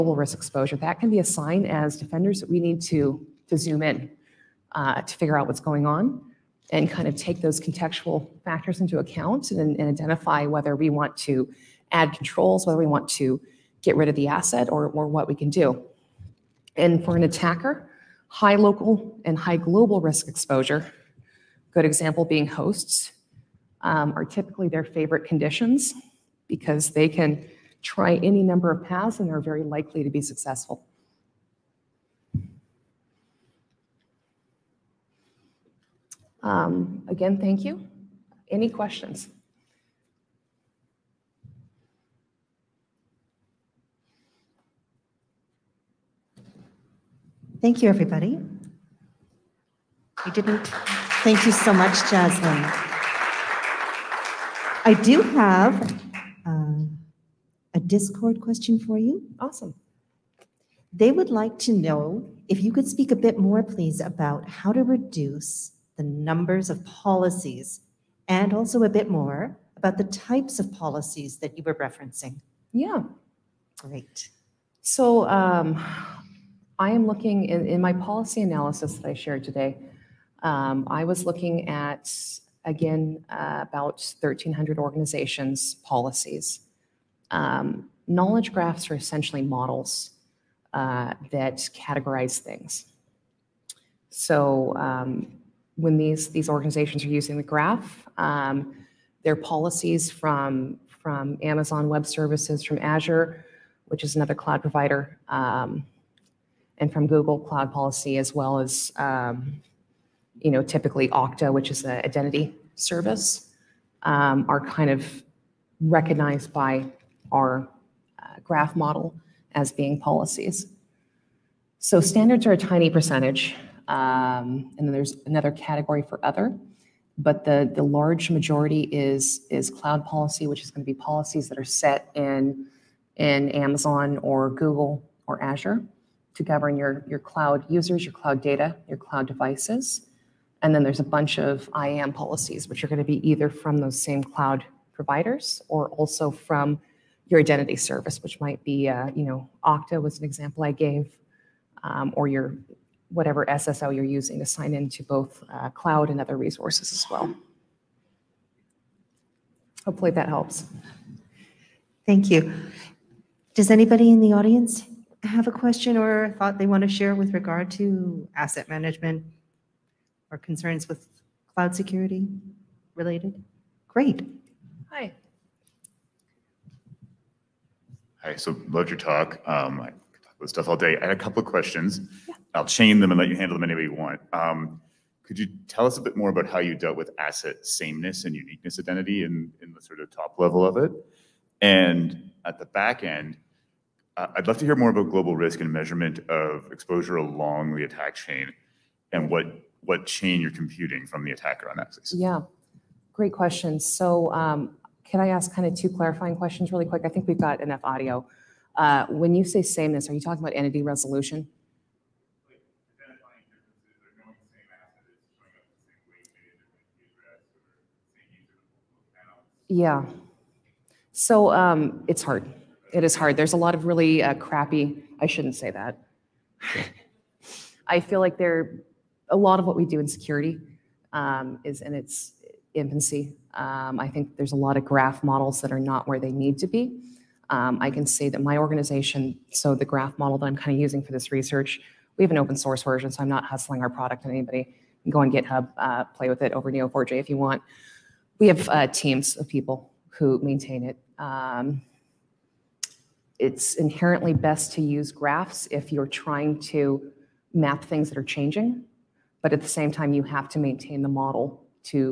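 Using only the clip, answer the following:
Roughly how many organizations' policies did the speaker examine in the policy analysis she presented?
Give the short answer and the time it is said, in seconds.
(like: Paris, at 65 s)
1,300, at 84 s.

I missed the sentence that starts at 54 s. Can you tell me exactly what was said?
I do have Discord question for you.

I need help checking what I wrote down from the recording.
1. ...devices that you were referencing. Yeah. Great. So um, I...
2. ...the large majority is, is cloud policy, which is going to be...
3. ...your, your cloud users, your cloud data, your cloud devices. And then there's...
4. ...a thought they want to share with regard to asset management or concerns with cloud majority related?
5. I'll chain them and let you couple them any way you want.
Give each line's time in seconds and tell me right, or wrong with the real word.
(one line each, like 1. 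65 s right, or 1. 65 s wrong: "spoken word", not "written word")
1. 70 s wrong: "policies", not "devices"
2. 127 s right
3. 136 s right
4. 166 s wrong: "security", not "majority"
5. 182 s wrong: "handle", not "couple".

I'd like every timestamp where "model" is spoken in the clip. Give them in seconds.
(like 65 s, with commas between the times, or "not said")
89 s, 118 s, 235 s, 240 s, 261 s.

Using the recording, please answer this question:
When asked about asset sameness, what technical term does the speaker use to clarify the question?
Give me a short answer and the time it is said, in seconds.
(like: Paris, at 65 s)
Entity resolution, at 210 s.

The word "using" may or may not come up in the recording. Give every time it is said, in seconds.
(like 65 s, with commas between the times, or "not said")
97 s, 154 s, 240 s.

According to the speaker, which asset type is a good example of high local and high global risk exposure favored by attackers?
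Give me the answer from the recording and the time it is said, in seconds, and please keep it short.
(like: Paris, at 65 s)
Hosts, at 22 s.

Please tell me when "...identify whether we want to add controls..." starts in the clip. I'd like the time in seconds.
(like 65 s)
9 s.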